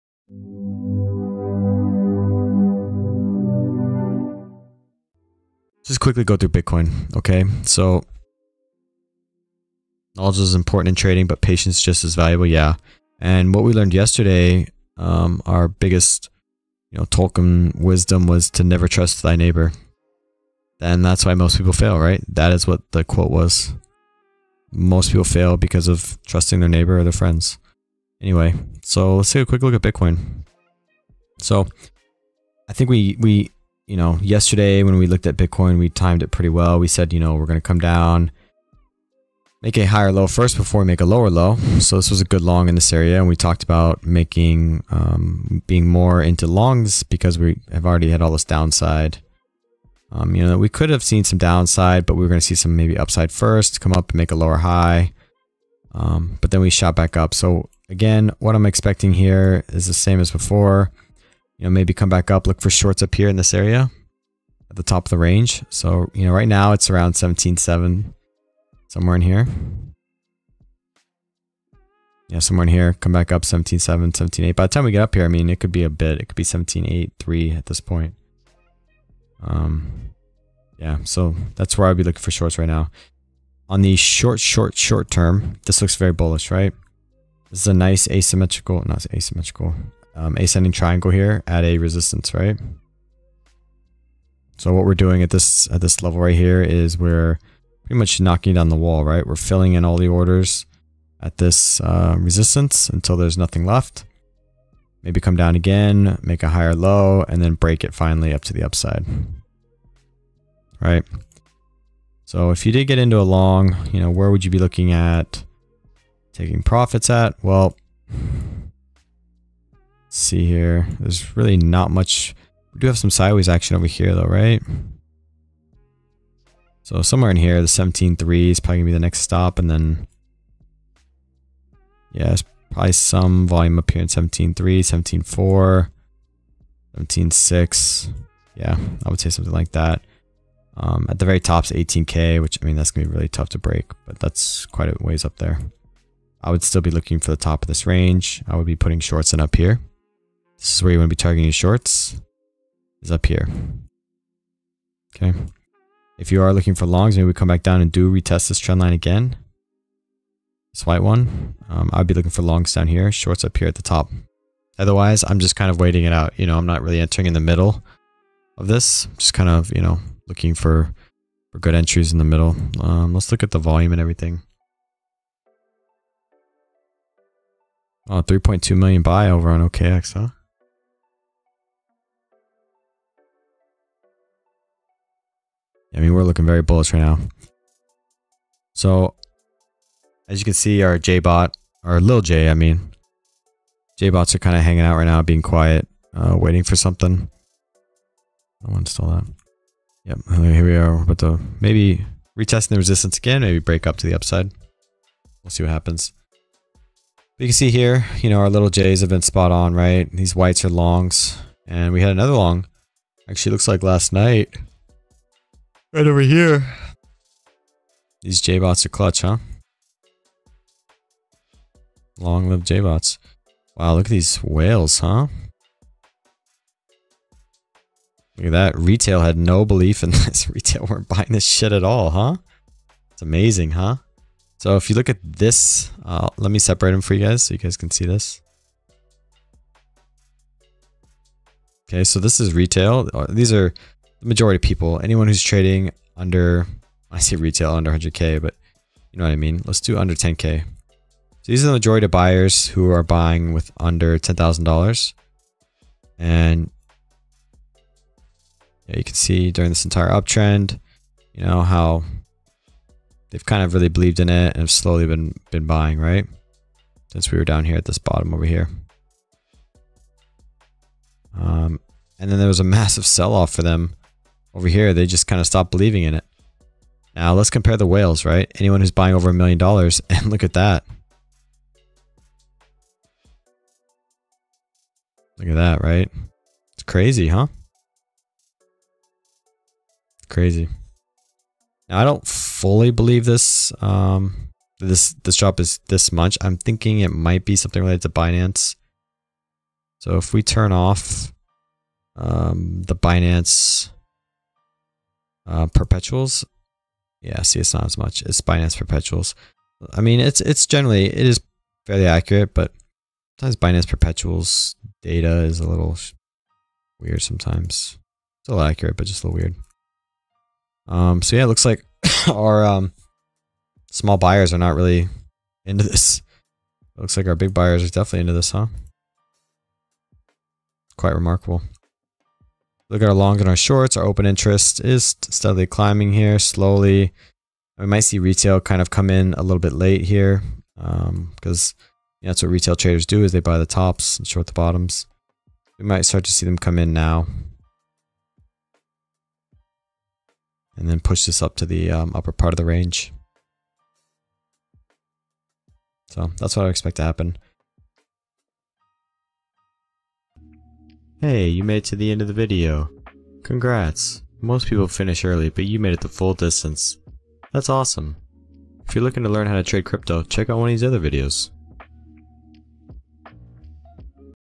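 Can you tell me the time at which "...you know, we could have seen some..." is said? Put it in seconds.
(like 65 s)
50 s.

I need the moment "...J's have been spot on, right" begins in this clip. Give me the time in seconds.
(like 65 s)
208 s.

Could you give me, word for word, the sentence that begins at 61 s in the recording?
You know, maybe come back up, look for shorts up here in this area at the top of the range.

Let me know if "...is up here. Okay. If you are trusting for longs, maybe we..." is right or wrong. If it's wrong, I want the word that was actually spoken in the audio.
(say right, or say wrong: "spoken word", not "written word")
wrong: "looking", not "trusting".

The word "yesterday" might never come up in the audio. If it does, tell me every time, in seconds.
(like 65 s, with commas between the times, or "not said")
13 s, 34 s.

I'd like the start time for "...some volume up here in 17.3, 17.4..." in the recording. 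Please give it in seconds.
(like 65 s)
132 s.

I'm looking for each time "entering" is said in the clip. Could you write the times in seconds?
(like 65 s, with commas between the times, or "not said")
166 s.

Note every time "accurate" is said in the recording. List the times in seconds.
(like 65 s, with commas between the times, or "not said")
312 s, 318 s.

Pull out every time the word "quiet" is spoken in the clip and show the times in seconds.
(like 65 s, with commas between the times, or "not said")
195 s.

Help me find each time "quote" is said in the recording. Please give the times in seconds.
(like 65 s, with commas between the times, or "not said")
23 s.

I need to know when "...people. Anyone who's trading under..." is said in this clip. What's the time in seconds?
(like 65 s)
244 s.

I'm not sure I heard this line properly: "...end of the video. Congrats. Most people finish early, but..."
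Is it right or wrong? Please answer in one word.
right.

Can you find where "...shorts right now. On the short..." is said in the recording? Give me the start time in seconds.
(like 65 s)
82 s.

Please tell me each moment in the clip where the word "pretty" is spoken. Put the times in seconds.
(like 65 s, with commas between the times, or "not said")
36 s, 97 s.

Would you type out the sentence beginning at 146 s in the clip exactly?
I would still be looking for the top of this range.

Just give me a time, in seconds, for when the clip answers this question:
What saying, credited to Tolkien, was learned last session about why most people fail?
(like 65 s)
18 s.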